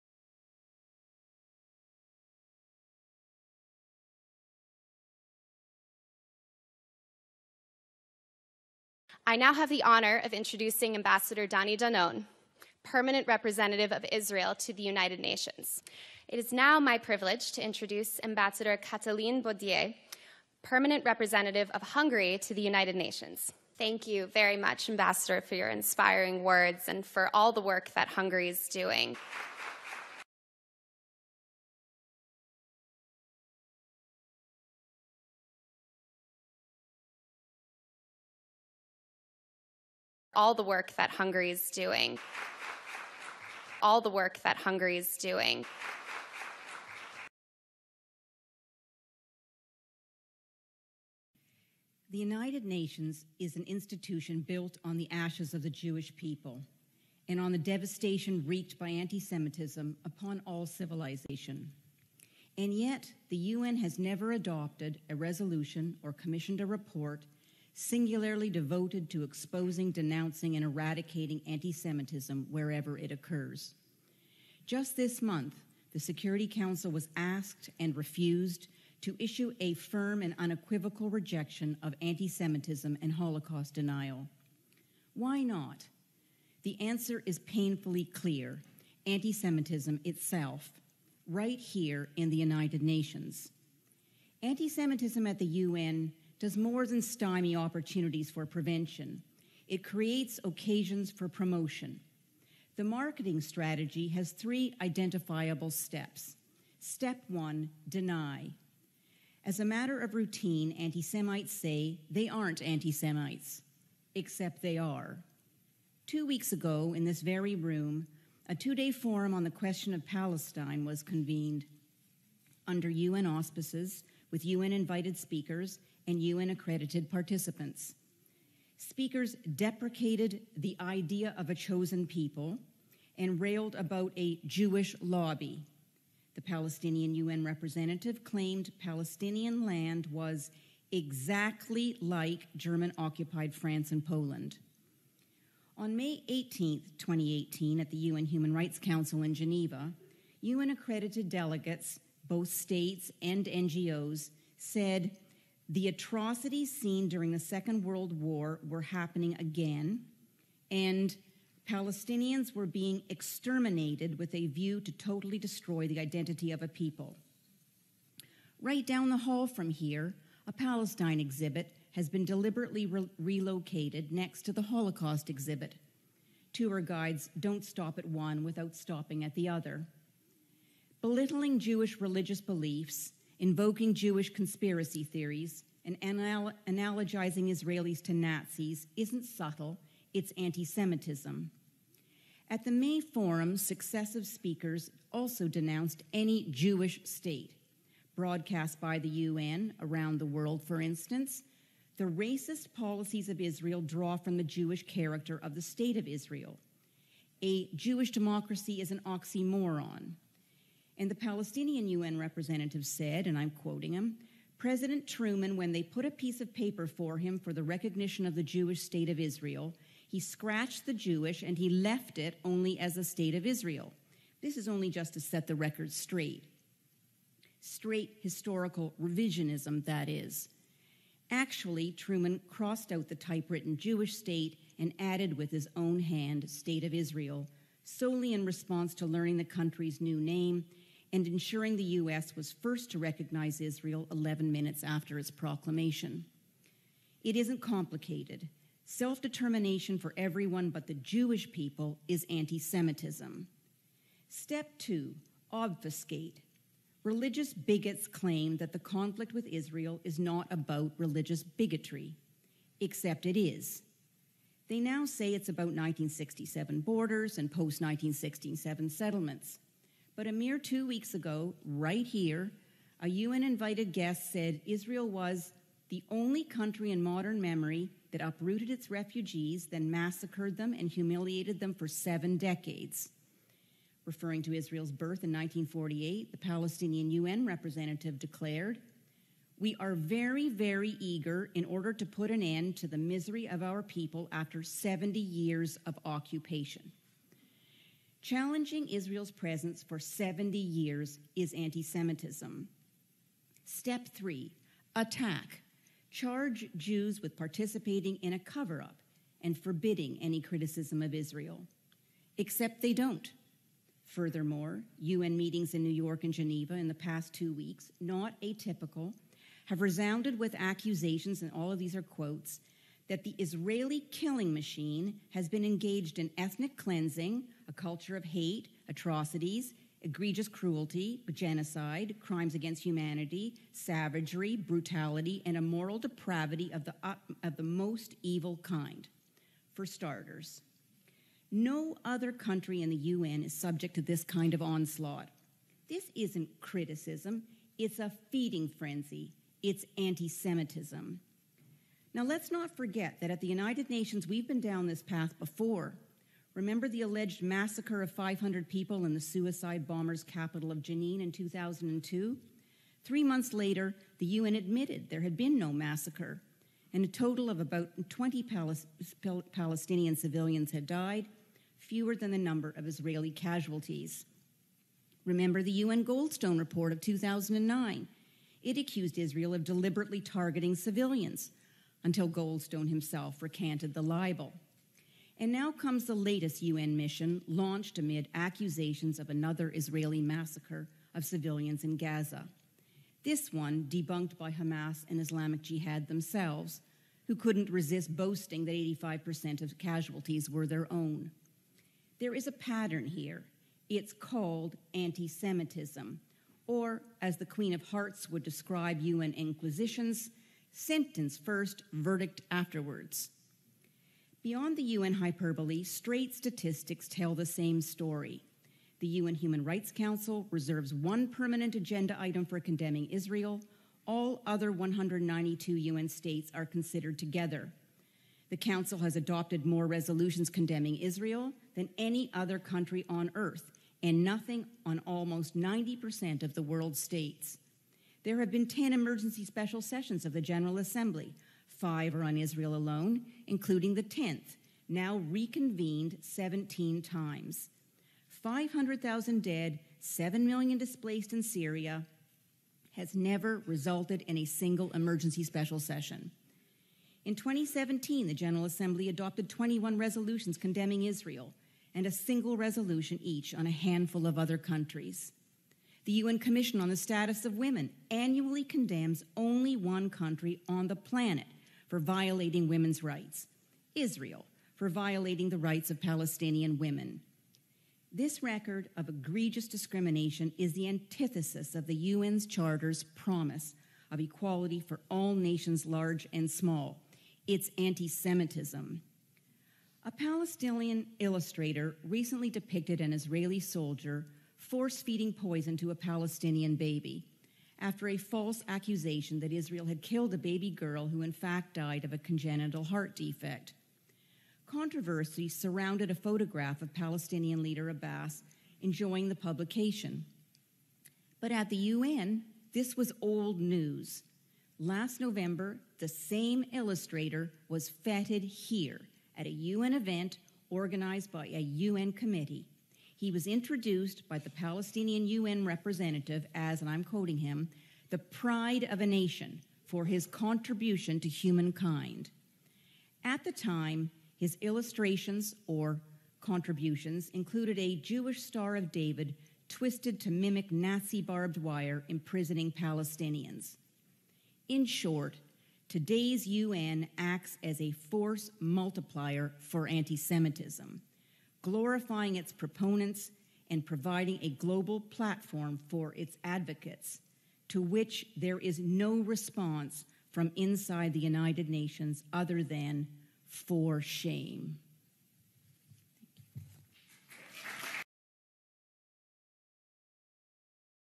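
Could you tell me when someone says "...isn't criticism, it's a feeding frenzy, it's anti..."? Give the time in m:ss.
5:46.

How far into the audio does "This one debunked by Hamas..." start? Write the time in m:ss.
6:33.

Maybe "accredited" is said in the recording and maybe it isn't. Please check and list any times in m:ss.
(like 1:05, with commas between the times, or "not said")
2:06, 2:30.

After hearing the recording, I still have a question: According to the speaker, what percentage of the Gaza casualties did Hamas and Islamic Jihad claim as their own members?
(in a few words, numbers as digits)
85%.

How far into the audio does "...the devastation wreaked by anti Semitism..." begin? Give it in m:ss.
0:57.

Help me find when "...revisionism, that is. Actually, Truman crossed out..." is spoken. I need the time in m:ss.
3:49.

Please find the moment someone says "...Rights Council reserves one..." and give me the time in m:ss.
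6:59.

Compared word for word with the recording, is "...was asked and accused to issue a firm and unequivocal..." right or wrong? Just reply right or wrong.
wrong.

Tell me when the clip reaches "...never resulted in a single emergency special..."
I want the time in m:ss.
7:33.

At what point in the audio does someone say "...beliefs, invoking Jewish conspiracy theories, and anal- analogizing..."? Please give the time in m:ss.
3:02.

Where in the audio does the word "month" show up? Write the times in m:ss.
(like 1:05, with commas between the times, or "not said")
1:15, 6:03.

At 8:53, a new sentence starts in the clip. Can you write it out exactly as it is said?
At the time, his illustrations or contributions included a Jewish Star of David twisted to mimic Nazi barbed wire imprisoning Palestinians.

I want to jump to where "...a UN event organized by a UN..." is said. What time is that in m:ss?
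8:39.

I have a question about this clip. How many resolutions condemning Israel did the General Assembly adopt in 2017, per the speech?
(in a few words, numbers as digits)
21.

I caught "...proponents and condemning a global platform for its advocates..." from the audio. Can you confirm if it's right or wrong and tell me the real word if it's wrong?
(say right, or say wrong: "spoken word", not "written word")
wrong: "providing", not "condemning".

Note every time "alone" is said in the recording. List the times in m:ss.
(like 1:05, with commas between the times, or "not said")
7:22.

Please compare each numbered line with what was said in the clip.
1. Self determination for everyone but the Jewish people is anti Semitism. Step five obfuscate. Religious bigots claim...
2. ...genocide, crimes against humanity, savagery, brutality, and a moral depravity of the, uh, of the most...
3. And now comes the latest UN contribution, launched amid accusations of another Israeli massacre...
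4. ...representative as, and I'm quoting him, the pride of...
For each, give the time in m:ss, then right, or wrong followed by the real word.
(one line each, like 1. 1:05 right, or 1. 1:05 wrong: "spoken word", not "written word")
1. 4:08 wrong: "two", not "five"
2. 5:31 right
3. 6:25 wrong: "mission", not "contribution"
4. 8:45 right.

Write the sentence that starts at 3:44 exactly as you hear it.
This is only just to set the record straight.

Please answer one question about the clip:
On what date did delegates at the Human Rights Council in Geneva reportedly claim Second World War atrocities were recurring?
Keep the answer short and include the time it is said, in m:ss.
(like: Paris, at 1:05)
May 18, 2018, at 2:25.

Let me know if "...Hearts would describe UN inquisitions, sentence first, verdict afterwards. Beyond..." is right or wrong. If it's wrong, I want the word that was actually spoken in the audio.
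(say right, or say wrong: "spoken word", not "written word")
right.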